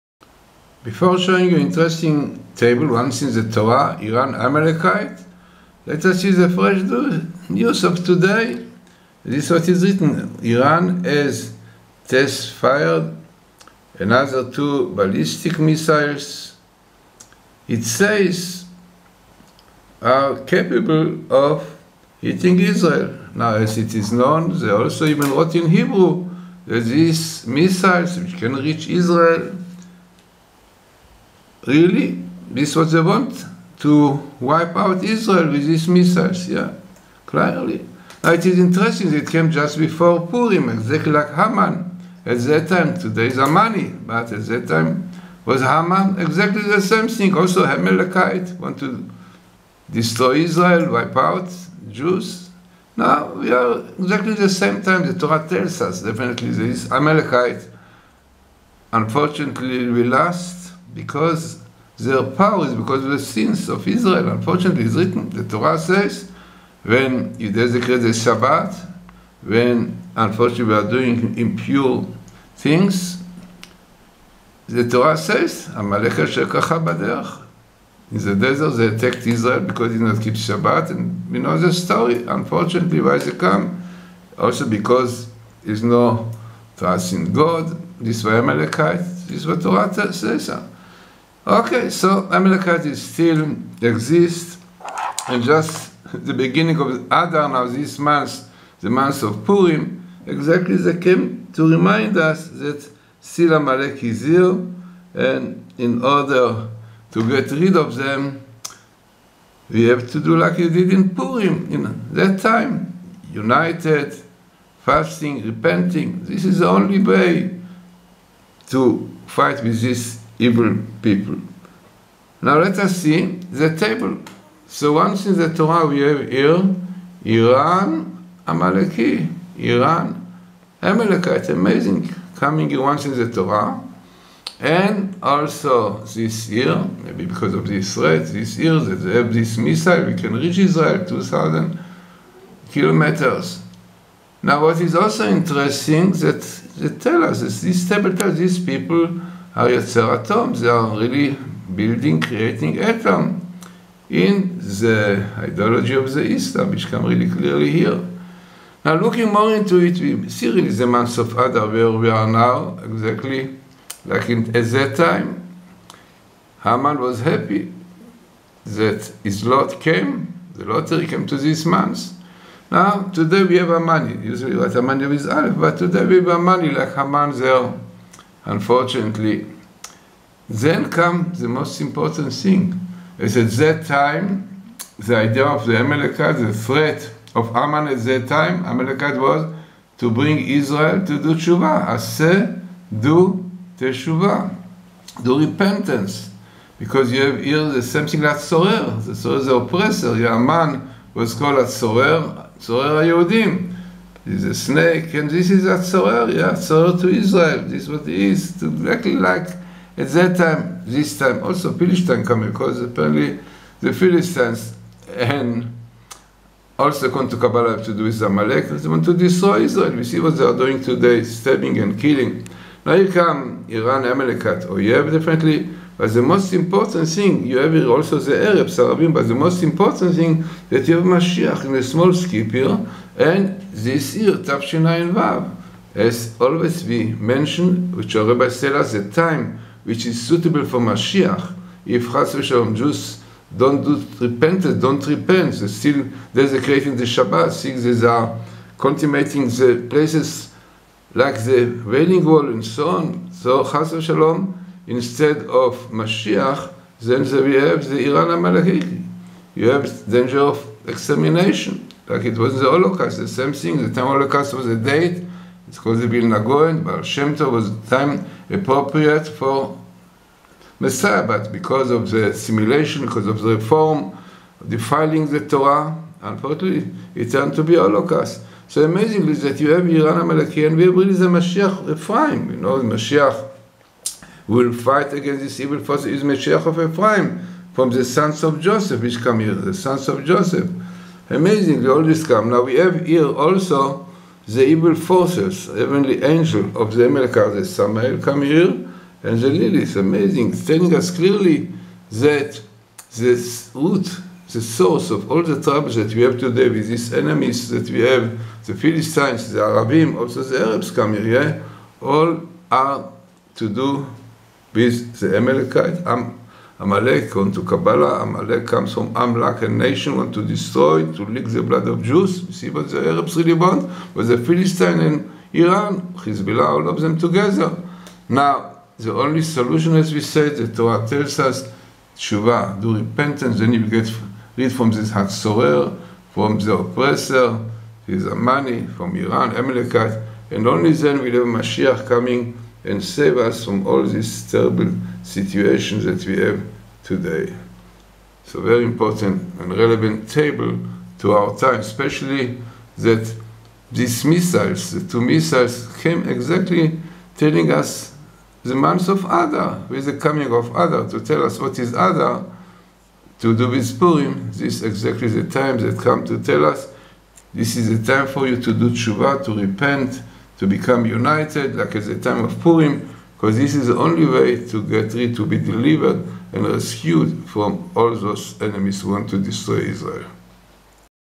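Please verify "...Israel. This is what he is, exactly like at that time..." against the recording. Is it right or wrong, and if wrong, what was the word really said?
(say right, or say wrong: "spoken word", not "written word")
right.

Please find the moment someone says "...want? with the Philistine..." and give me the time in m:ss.
5:23.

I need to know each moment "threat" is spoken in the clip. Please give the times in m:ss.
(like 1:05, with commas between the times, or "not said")
2:17, 3:06.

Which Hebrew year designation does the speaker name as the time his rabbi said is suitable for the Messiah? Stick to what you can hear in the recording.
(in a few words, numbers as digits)
Tavshinai Vav.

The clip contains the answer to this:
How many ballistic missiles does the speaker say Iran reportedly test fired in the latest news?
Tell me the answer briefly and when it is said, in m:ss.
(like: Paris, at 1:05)
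2, at 0:13.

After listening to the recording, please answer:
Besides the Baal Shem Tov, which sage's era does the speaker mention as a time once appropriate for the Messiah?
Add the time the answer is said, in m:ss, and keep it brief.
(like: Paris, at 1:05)
The Vilna Gaon, at 4:26.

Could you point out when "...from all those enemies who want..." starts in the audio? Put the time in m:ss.
6:17.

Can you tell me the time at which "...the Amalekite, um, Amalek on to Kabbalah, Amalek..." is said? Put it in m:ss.
5:15.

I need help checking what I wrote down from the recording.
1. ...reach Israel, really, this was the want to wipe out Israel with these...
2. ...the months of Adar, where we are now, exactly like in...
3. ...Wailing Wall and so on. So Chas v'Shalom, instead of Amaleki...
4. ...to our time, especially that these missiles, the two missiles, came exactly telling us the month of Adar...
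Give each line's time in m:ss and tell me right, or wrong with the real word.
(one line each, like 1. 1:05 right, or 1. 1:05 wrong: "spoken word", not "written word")
1. 0:28 right
2. 2:40 right
3. 4:11 wrong: "Mashiach", not "Amaleki"
4. 5:51 right.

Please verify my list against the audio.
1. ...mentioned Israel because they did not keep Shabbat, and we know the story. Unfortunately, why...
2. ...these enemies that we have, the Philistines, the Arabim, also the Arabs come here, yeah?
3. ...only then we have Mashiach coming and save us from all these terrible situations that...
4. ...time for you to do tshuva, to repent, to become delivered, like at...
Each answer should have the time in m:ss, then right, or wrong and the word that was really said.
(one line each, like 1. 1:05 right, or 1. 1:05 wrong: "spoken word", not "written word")
1. 1:18 wrong: "attacked", not "mentioned"
2. 5:06 right
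3. 5:40 right
4. 6:08 wrong: "united", not "delivered".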